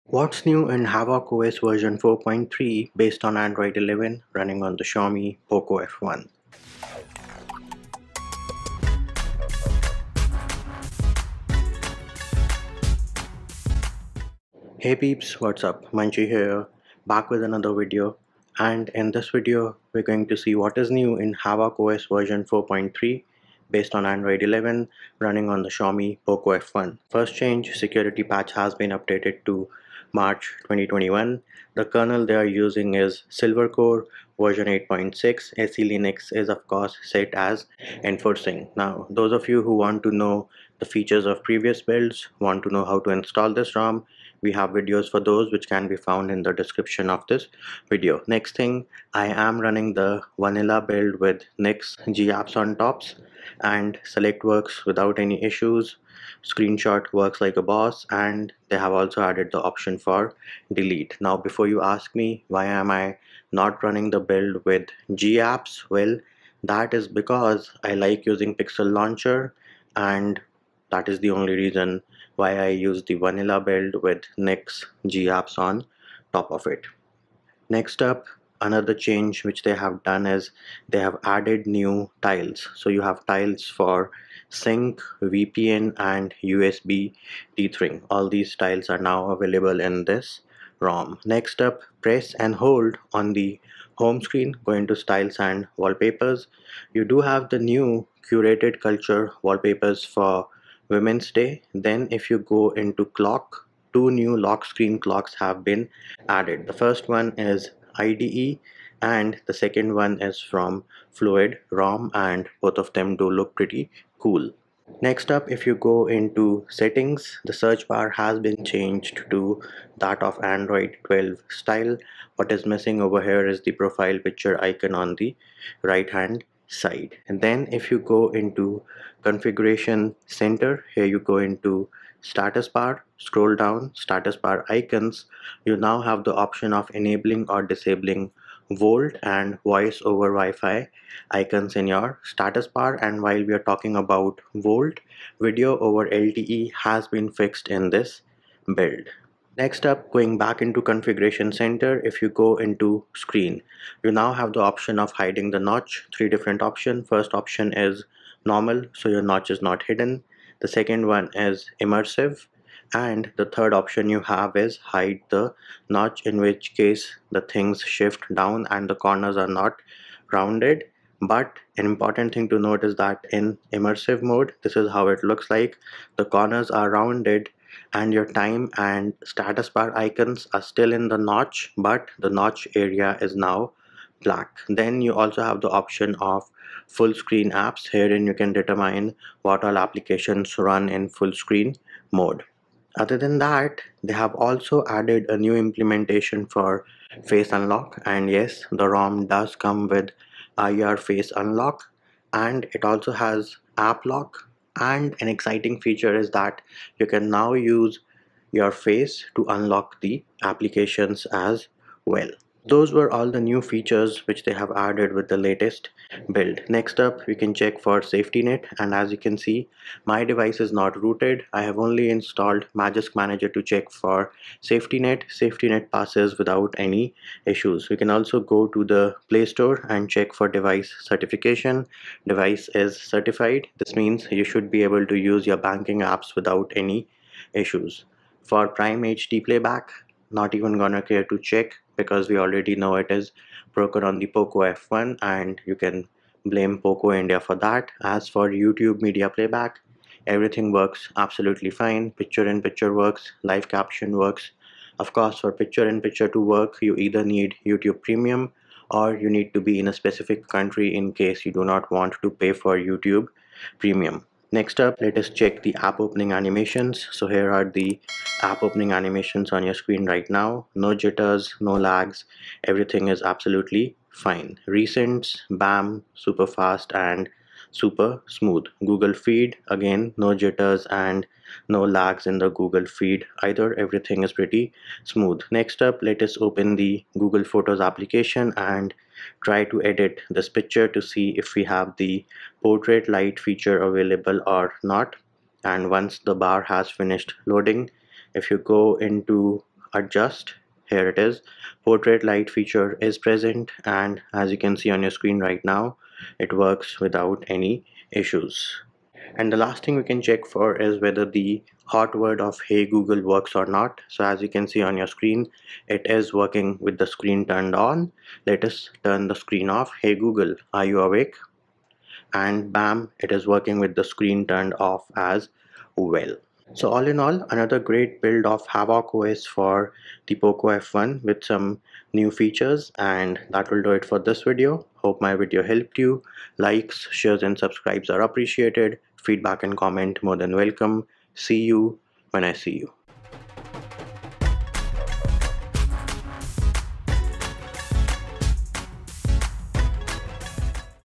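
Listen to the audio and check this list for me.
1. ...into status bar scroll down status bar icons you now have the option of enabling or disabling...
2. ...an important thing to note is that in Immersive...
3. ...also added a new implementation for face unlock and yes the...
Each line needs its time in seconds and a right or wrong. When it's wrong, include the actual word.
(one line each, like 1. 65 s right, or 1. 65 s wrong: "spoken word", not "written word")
1. 131 s right
2. 171 s right
3. 194 s right.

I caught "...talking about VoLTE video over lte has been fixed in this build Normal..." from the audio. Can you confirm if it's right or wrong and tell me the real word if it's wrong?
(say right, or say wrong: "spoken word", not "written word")
wrong: "Next", not "Normal".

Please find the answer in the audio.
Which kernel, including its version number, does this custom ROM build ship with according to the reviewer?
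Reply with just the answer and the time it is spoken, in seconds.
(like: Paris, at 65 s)
Silvercore 8.6, at 33 s.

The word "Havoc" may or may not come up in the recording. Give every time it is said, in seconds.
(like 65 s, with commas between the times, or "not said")
0 s, 21 s, 328 s.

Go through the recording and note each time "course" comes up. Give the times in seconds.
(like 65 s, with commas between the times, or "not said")
36 s, 255 s.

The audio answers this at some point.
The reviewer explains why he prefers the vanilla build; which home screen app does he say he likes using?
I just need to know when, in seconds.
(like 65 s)
68 s.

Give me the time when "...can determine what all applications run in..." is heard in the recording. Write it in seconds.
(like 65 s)
188 s.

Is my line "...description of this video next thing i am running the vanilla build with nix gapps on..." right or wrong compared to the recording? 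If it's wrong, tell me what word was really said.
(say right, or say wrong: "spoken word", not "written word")
right.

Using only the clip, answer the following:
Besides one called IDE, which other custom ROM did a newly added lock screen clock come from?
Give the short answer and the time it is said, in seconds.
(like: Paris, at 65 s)
Fluid ROM, at 111 s.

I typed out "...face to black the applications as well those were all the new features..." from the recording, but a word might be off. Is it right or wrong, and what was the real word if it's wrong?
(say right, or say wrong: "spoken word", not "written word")
wrong: "unlock", not "black".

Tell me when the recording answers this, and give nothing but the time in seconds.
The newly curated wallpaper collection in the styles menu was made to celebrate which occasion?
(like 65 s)
100 s.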